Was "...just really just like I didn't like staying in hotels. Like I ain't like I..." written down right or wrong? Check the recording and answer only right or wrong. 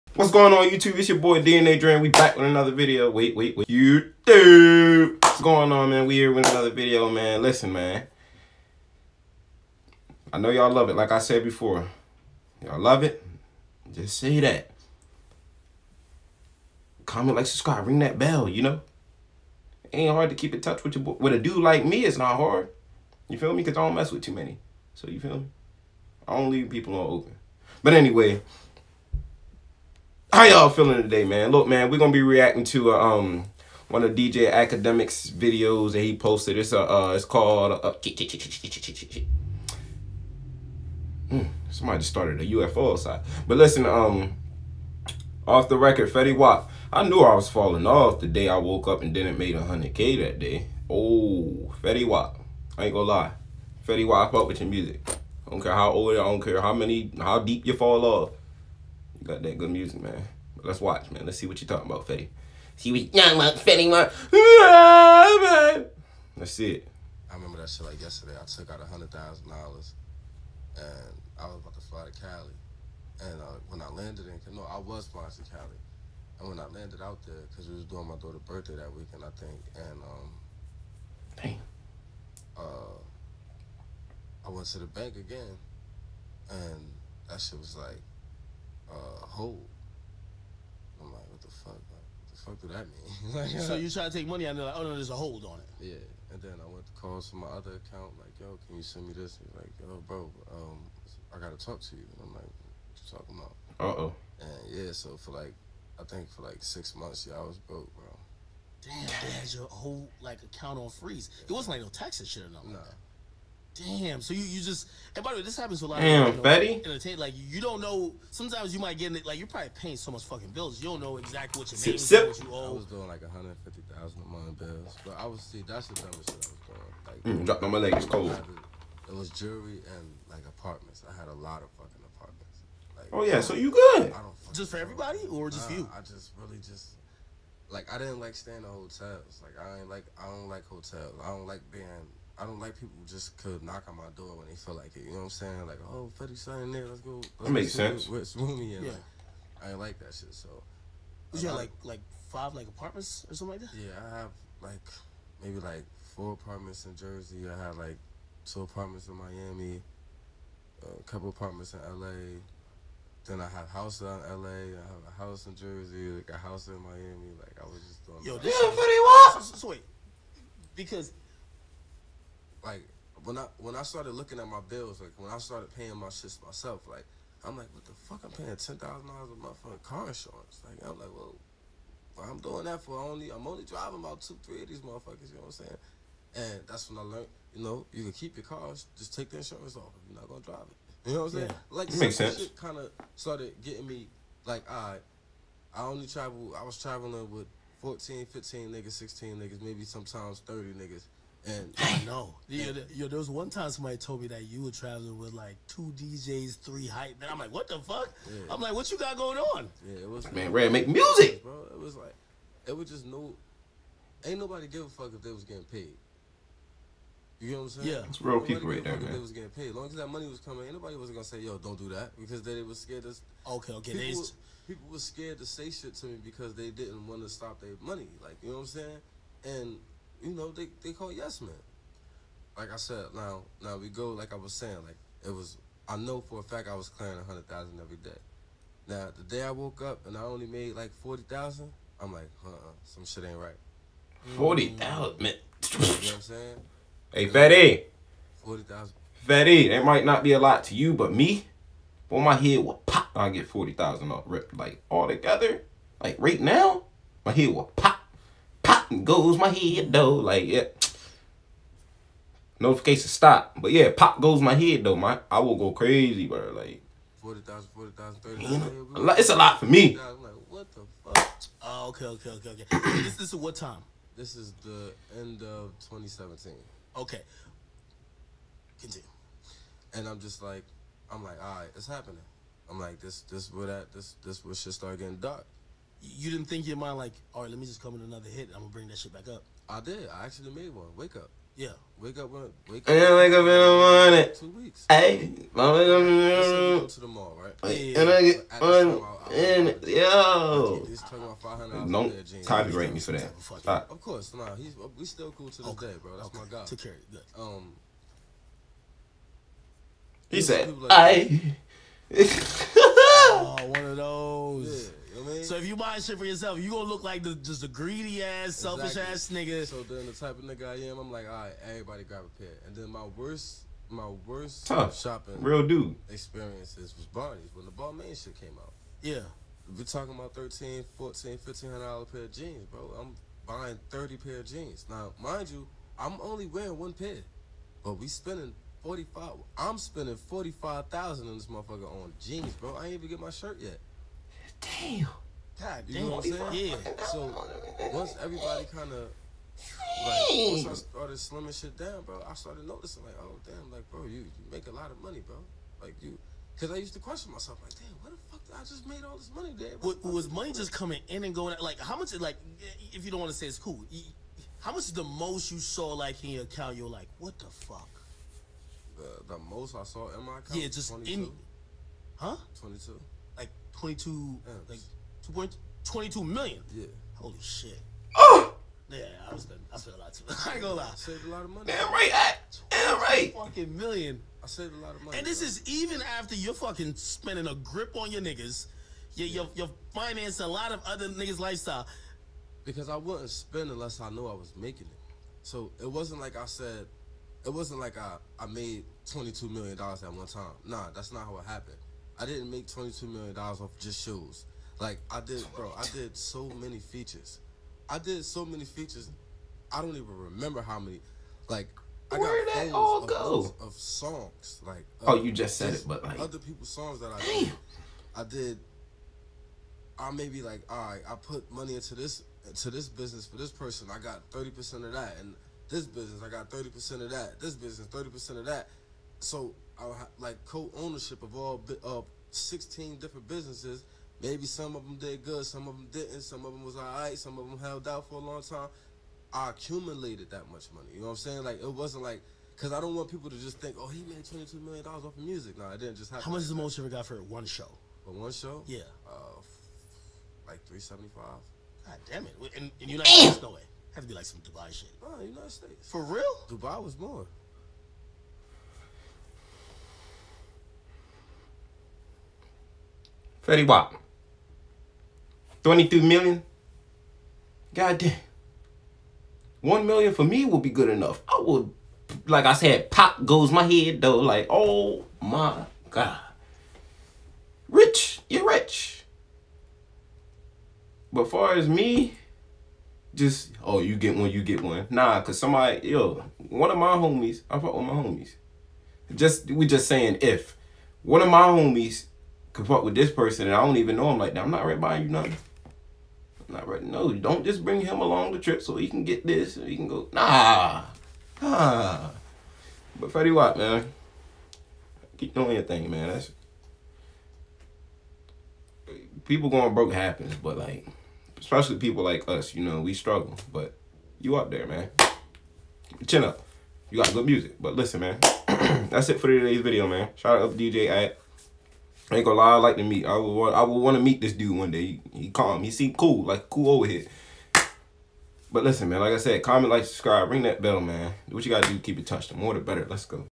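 right.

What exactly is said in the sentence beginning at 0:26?
I don't leave people on open.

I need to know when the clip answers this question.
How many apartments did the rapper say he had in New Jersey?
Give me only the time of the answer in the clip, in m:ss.
2:36.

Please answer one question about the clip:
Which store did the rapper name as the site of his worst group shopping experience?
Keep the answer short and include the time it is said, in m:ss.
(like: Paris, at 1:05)
Barney's, at 5:27.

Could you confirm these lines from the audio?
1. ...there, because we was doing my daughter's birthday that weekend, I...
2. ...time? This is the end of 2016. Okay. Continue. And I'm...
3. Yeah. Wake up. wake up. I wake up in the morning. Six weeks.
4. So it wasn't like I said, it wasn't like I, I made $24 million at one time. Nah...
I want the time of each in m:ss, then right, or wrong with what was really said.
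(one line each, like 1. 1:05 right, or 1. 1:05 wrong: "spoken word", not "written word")
1. 1:17 right
2. 4:33 wrong: "2017", not "2016"
3. 4:51 wrong: "Two", not "Six"
4. 6:35 wrong: "22", not "24".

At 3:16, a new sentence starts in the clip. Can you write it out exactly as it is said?
I was traveling with 14, 15 niggas, 16 niggas, maybe sometimes 30 niggas.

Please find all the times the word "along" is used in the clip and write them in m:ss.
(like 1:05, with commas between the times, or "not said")
8:17.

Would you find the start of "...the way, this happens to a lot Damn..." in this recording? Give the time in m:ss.
1:55.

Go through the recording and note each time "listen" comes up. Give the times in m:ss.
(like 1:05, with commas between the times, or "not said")
0:07, 0:43, 8:37, 8:48.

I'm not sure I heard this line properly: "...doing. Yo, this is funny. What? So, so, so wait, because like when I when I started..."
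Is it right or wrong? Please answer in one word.
right.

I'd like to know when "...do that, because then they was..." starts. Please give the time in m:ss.
3:41.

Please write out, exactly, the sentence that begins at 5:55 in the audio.
Like you, because I used to question myself, like, damn, what the fuck did I just made all this money, dad?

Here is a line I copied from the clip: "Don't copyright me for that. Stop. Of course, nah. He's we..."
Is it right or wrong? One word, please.
right.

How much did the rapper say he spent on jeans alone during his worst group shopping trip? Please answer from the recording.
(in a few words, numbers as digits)
$45,000.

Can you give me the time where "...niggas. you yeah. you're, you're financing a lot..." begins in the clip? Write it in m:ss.
6:28.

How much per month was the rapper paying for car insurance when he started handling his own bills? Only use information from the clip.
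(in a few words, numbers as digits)
$10,000.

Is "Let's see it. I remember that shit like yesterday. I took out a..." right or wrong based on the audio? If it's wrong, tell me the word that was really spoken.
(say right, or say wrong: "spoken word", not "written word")
right.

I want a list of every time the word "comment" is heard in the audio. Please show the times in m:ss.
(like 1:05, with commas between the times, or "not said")
0:17, 8:49.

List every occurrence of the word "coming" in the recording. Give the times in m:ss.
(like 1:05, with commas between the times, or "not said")
3:40, 6:00.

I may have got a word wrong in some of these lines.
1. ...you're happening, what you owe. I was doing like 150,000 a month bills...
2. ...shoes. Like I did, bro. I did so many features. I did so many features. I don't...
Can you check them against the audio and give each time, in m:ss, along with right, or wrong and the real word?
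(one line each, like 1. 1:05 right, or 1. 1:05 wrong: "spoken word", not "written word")
1. 2:01 wrong: "making", not "happening"
2. 6:44 right.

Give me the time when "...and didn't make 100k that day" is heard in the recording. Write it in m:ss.
0:49.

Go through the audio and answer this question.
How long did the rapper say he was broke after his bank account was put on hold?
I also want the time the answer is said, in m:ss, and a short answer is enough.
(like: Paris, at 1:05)
6 months, at 1:46.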